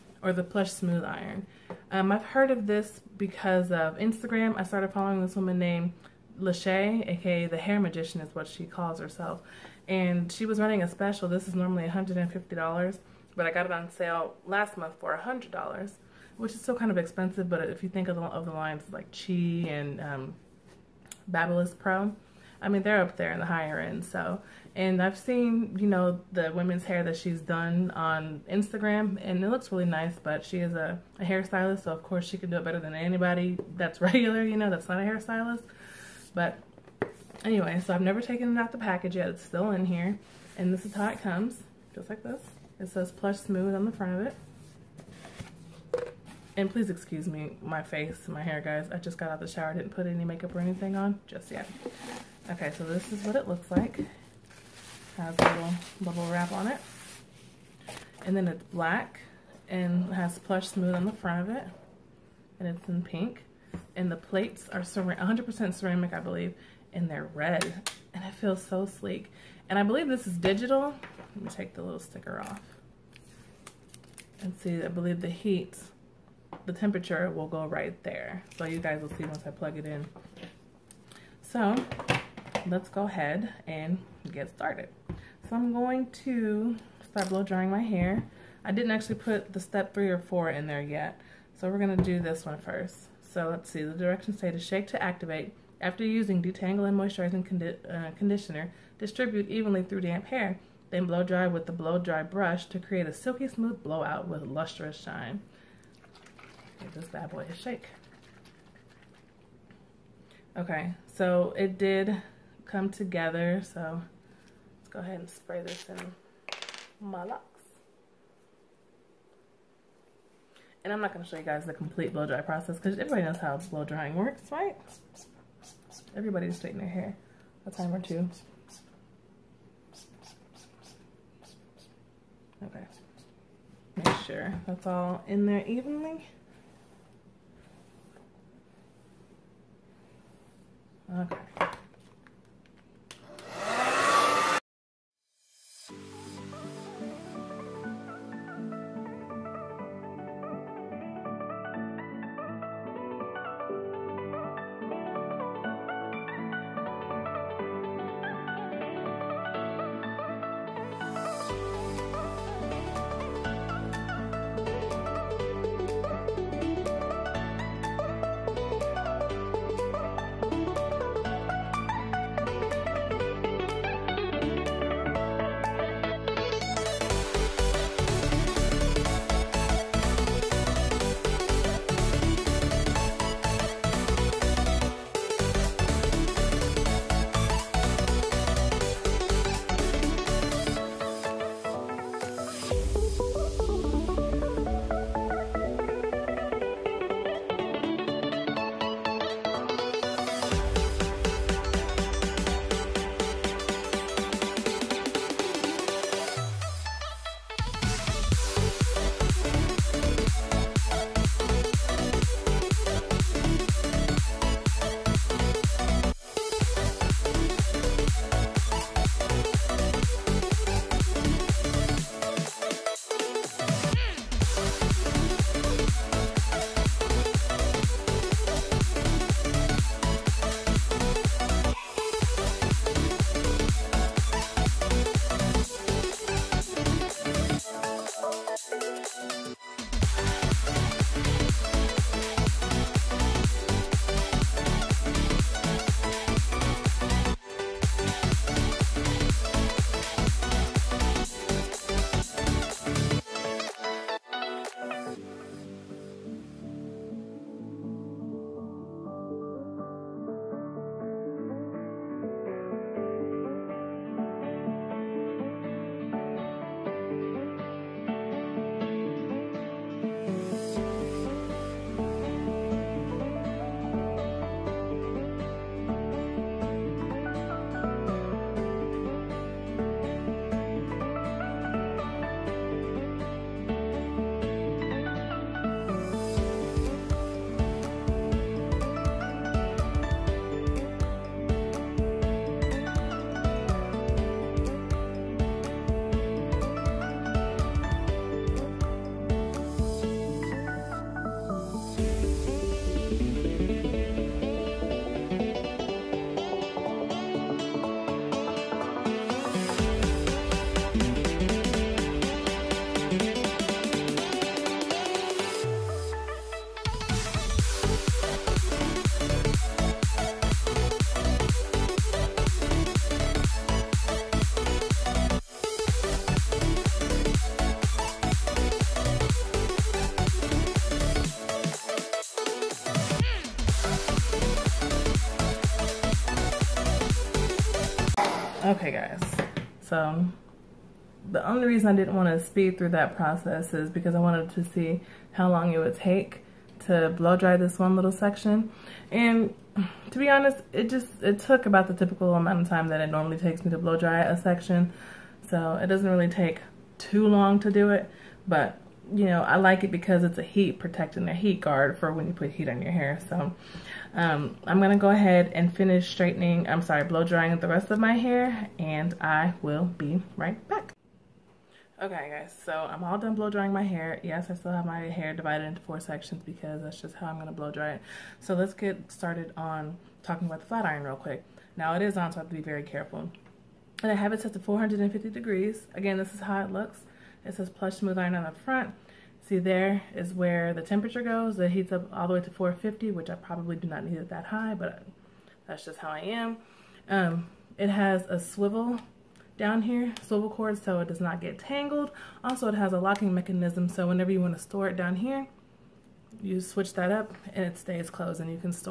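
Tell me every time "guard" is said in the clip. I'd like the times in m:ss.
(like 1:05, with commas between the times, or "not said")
6:01.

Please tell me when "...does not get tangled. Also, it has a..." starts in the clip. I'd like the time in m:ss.
6:41.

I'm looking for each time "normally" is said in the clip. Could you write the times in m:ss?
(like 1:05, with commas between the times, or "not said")
0:11, 5:53.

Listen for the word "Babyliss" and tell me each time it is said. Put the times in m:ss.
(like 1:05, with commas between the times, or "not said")
0:21.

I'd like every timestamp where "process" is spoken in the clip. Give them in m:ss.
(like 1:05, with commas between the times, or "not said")
2:02, 5:43.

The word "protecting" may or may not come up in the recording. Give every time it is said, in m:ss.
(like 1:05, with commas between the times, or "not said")
6:00.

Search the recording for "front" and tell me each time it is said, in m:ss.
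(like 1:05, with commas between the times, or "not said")
0:43, 1:01, 6:28.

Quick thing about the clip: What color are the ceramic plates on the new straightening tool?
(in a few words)
Red.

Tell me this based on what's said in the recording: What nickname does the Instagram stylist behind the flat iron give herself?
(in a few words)
the hair magician.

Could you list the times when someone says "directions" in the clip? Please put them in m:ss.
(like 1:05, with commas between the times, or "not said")
1:33.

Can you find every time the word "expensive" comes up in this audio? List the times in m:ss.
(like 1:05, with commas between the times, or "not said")
0:16.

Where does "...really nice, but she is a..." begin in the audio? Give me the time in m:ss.
0:29.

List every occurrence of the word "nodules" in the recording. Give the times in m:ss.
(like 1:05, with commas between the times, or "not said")
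not said.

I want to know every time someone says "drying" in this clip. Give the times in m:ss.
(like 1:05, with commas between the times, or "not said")
1:27, 2:03, 6:07, 6:13.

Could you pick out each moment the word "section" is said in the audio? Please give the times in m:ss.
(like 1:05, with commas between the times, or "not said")
5:48, 5:54, 6:15.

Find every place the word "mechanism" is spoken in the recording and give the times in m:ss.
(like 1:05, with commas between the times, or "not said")
6:43.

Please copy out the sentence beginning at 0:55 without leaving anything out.
Has a little bubble wrap on it.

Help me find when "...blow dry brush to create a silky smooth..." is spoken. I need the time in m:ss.
1:41.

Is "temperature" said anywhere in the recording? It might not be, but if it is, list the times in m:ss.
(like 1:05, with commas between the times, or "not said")
1:16, 6:30.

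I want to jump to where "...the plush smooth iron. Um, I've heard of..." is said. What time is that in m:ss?
0:00.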